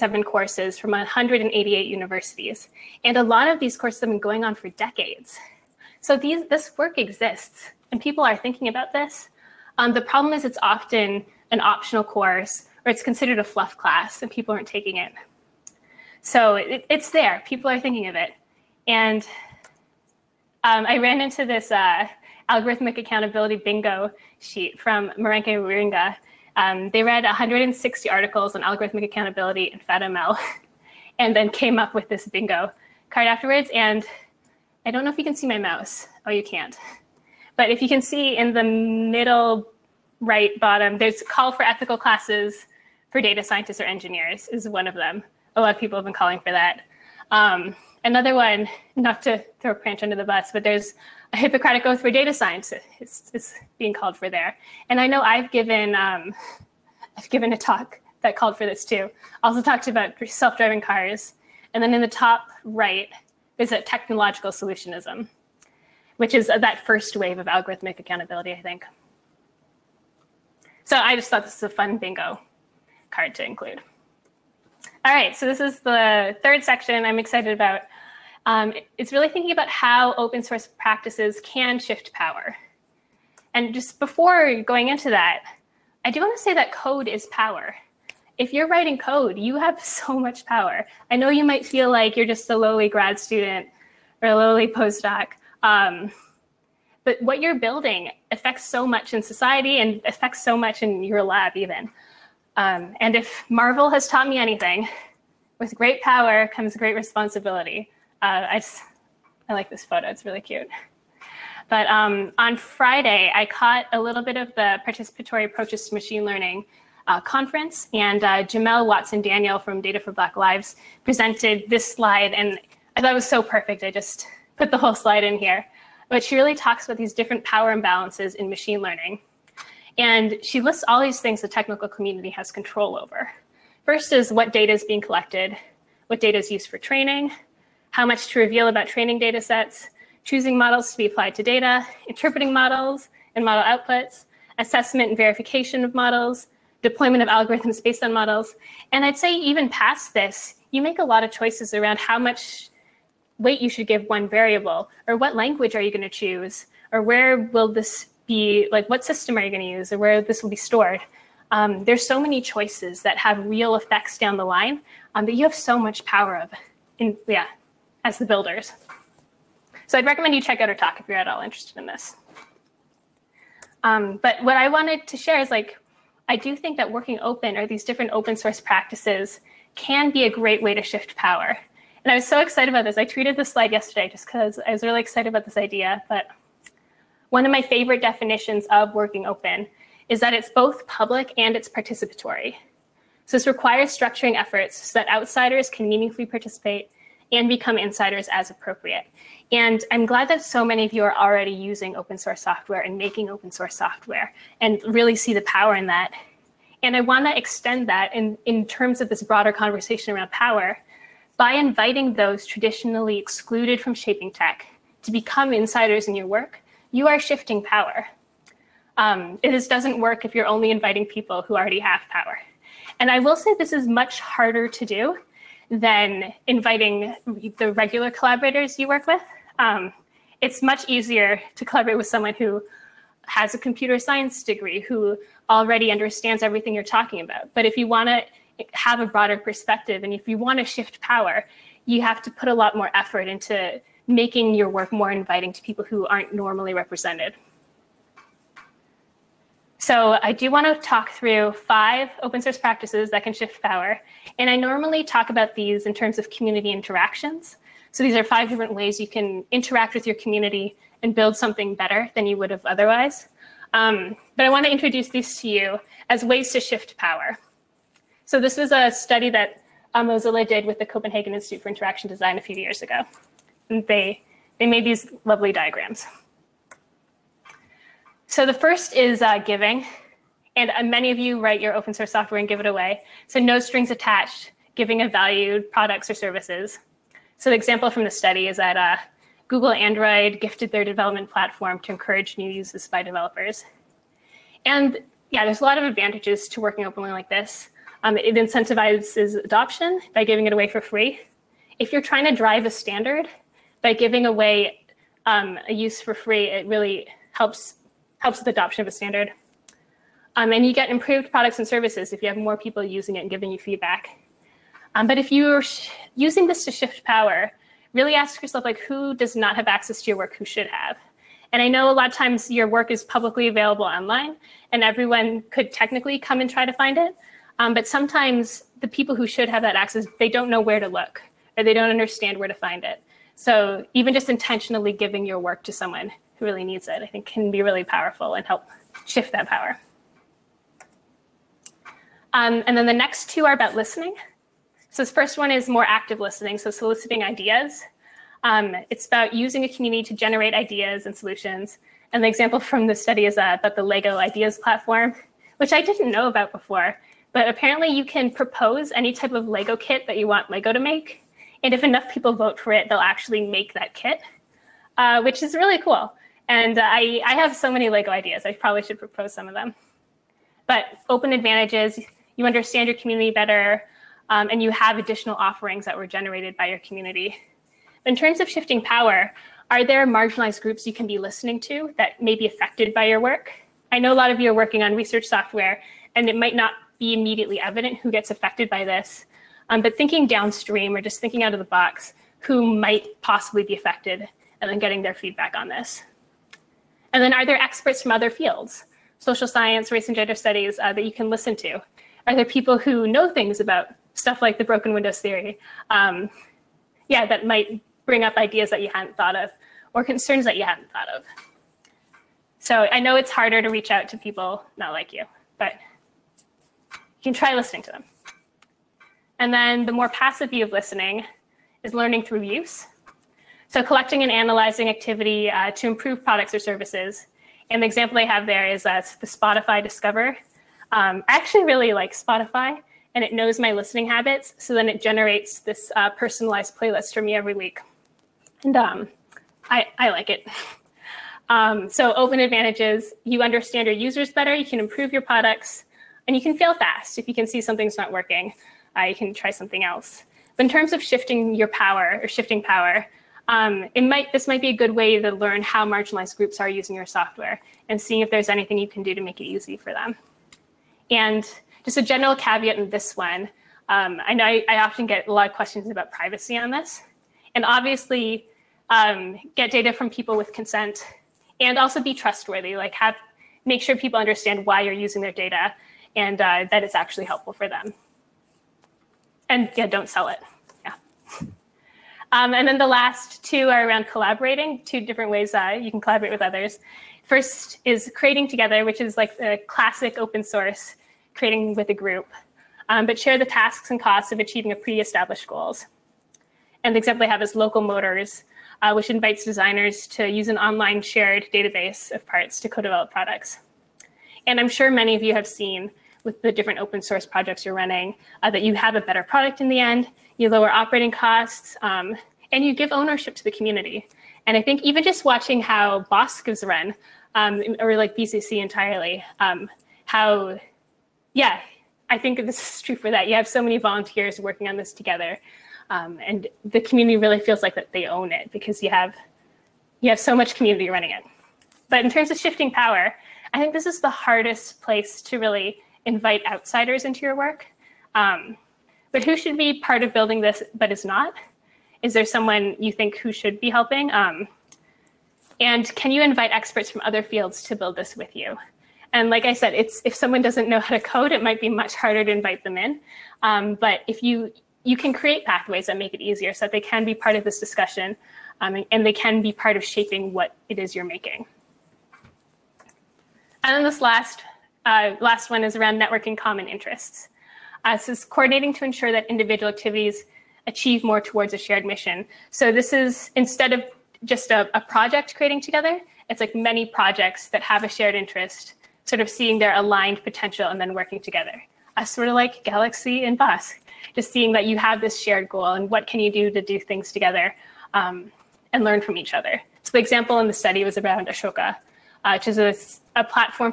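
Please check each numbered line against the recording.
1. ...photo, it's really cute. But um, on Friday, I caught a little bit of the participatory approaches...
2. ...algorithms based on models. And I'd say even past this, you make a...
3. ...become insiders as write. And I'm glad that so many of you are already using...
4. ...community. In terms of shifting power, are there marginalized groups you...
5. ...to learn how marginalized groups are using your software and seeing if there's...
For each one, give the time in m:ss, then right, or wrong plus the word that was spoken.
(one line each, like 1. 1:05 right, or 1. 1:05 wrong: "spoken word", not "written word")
1. 1:49 right
2. 2:27 right
3. 3:17 wrong: "appropriate", not "write"
4. 6:16 right
5. 7:35 right.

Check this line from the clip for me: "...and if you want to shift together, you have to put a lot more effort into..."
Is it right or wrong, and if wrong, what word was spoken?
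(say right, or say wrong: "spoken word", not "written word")
wrong: "power", not "together".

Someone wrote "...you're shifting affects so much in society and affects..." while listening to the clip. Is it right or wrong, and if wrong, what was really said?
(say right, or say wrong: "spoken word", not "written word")
wrong: "building", not "shifting".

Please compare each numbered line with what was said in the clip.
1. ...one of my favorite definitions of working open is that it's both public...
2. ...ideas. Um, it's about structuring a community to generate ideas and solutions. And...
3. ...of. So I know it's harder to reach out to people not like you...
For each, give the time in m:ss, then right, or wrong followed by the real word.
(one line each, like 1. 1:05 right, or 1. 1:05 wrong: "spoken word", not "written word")
1. 3:07 right
2. 5:47 wrong: "using", not "structuring"
3. 6:51 right.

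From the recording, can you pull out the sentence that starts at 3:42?
And I will say this is much harder to do than inviting the regular collaborators you work with.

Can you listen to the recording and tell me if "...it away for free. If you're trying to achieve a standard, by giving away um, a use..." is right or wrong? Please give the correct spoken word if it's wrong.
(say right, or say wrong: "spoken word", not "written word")
wrong: "drive", not "achieve".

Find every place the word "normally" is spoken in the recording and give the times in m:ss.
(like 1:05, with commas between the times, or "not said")
4:06, 4:14.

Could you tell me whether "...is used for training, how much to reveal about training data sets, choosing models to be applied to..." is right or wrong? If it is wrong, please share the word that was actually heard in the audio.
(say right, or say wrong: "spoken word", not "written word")
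right.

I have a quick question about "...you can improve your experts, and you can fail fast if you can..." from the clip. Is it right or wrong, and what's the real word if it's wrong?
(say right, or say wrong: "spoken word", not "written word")
wrong: "products", not "experts".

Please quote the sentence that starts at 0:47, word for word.
Um, another one, not to throw a crutch under the bus, but there's a Hippocratic oath for data science.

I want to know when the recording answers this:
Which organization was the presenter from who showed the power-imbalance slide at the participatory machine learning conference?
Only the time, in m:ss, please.
1:59.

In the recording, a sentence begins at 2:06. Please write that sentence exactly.
But she really talks about these different power imbalances in machine learning.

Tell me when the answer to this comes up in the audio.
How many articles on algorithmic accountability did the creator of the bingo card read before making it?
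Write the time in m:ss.
0:27.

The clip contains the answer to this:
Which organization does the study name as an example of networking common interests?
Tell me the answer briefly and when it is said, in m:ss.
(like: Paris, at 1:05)
Ashoka, at 9:51.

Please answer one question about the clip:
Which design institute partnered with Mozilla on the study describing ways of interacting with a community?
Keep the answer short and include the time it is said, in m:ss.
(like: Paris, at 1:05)
Copenhagen Institute for Interaction Design, at 4:30.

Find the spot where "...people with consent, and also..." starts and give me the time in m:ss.
7:50.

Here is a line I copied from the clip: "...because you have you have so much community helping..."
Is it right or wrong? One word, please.
wrong.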